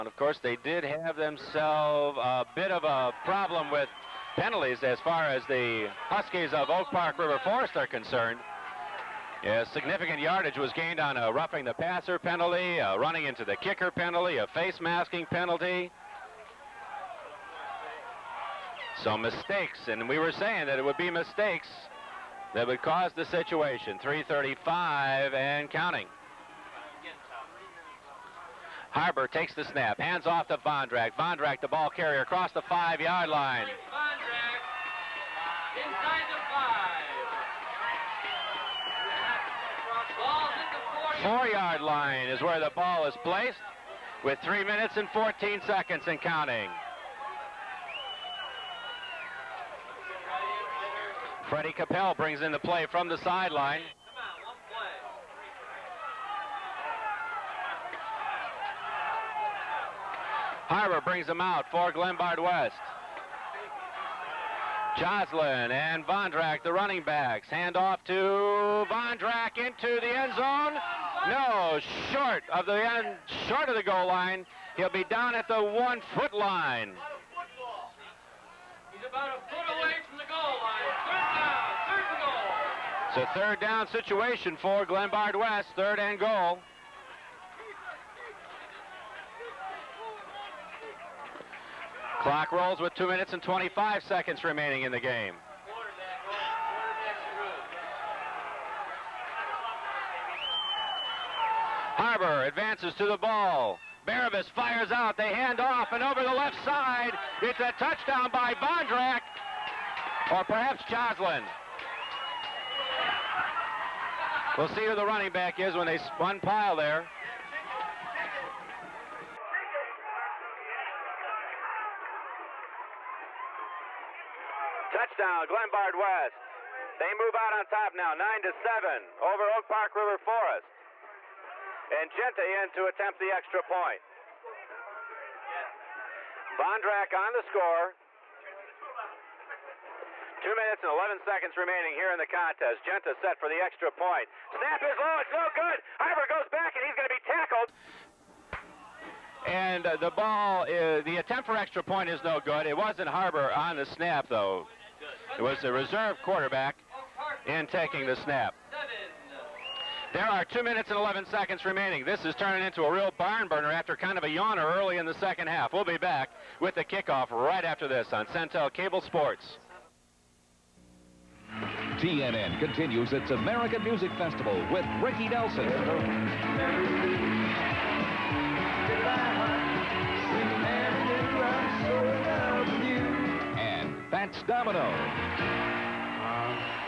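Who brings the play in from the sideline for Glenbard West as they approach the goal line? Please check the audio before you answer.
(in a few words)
Freddie Capel.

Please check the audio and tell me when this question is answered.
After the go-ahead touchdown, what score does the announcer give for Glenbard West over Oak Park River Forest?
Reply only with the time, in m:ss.
2:08.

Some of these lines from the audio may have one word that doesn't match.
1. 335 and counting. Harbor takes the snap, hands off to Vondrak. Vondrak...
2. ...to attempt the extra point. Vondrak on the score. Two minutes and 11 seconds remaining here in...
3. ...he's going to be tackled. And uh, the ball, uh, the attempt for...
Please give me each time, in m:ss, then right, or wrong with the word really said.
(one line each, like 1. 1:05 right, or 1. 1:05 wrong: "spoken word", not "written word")
1. 0:24 right
2. 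2:12 right
3. 2:26 right.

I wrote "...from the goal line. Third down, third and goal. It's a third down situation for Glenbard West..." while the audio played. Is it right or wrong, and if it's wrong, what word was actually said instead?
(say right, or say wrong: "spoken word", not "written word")
right.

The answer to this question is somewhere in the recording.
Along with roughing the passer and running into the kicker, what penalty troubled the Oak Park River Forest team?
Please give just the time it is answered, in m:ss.
0:14.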